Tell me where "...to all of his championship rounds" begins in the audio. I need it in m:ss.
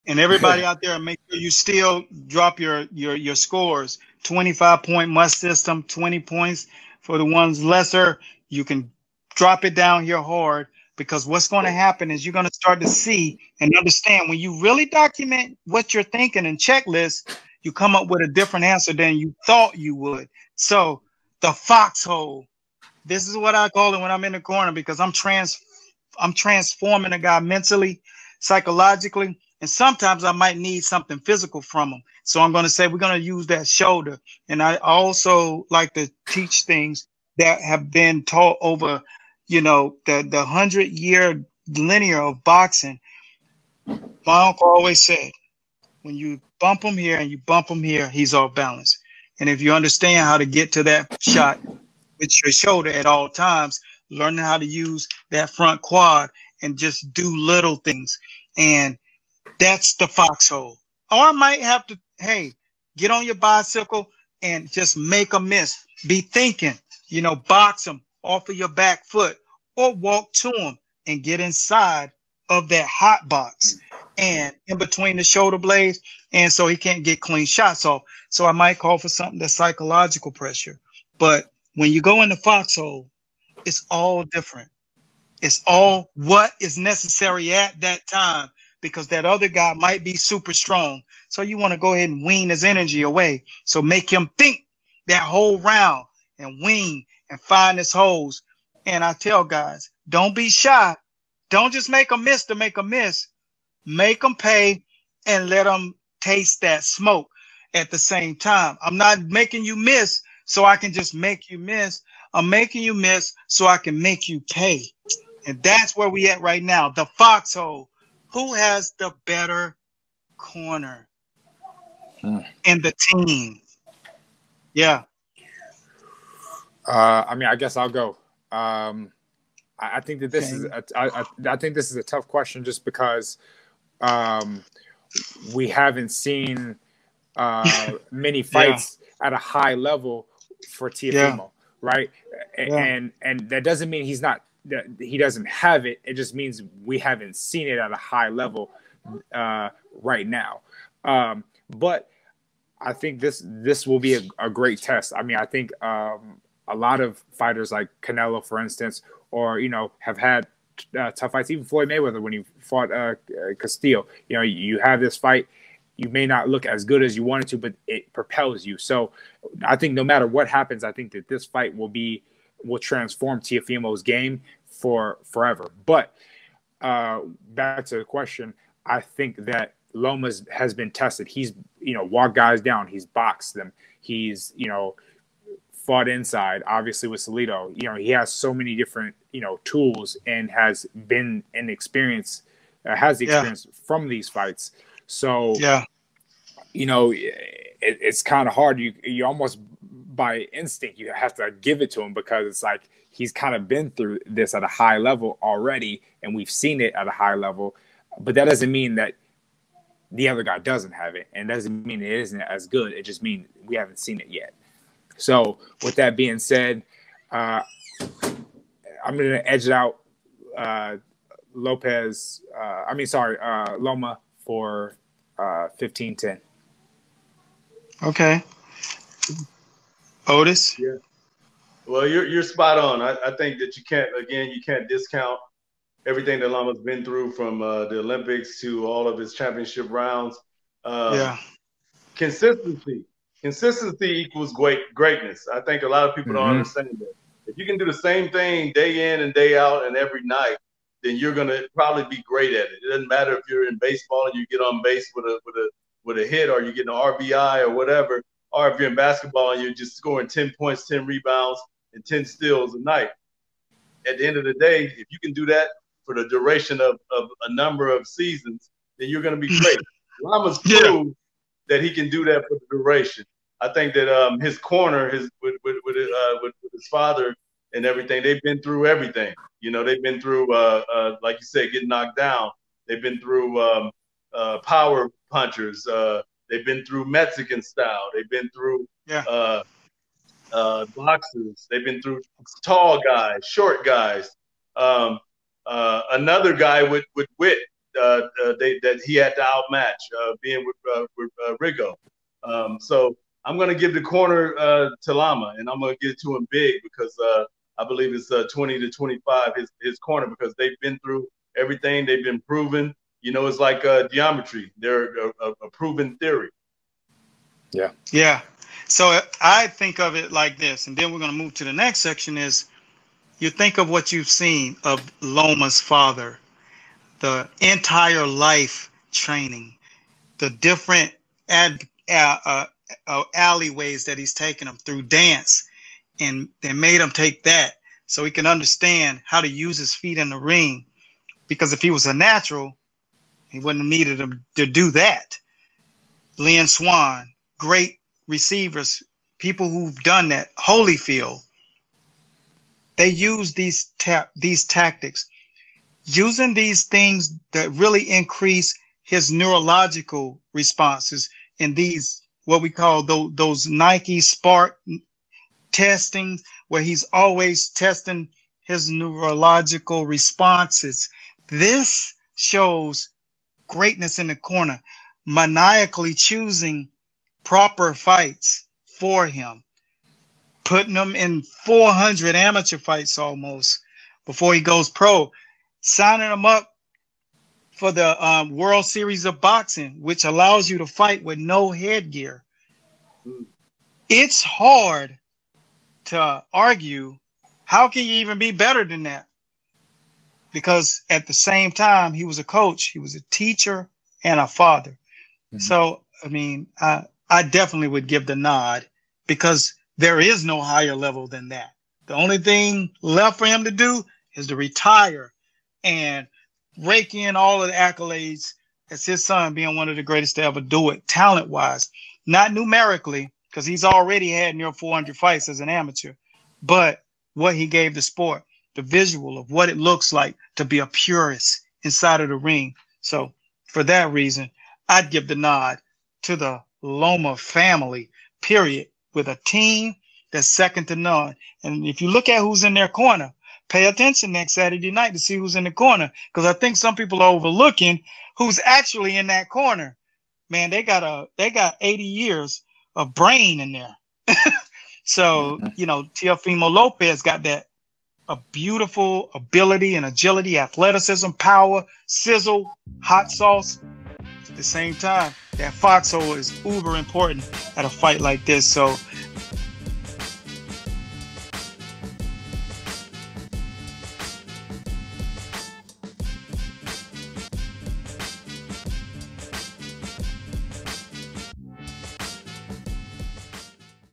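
3:58.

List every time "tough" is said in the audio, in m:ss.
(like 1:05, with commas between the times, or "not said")
2:12, 2:41.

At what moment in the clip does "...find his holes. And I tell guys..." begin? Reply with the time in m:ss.
1:37.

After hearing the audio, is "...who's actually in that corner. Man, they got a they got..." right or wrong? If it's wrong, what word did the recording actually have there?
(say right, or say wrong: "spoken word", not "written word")
right.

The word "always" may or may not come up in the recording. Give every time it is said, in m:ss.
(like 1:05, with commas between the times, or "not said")
0:44, 6:07.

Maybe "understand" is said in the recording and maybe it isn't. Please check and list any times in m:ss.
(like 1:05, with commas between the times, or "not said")
0:13, 0:49, 4:06, 5:38.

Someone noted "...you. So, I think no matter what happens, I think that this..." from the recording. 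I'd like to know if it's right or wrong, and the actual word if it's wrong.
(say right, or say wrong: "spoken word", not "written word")
right.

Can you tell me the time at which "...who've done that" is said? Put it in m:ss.
5:49.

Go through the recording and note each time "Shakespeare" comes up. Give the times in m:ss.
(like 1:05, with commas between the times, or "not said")
not said.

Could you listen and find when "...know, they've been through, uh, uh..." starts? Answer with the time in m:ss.
4:39.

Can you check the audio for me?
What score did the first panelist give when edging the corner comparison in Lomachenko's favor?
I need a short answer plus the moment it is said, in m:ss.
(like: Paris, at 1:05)
15-10, at 3:45.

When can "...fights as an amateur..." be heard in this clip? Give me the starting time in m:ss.
7:05.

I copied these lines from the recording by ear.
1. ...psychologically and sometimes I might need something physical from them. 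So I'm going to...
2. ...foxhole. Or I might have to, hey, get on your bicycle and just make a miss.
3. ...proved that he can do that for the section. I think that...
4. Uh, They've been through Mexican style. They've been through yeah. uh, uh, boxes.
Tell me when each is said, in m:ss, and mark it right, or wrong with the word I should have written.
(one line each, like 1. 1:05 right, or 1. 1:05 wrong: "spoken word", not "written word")
1. 0:28 right
2. 1:00 right
3. 4:30 wrong: "duration", not "section"
4. 4:45 right.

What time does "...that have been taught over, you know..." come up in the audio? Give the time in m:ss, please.
0:37.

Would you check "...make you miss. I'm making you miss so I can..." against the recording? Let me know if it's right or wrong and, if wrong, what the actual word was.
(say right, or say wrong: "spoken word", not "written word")
right.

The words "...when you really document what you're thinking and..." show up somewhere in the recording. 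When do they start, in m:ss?
0:14.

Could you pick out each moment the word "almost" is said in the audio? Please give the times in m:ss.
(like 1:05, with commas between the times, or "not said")
3:19, 6:23.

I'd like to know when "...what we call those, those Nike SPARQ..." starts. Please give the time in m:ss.
6:02.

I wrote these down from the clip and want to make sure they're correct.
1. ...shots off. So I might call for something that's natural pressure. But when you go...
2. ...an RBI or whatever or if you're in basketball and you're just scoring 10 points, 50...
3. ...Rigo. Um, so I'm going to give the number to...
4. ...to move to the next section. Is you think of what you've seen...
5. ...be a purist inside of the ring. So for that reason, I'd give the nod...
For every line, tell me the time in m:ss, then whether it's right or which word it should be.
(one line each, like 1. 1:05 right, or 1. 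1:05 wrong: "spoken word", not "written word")
1. 1:17 wrong: "psychological", not "natural"
2. 4:16 wrong: "10", not "50"
3. 5:01 wrong: "corner", not "number"
4. 5:21 right
5. 7:10 right.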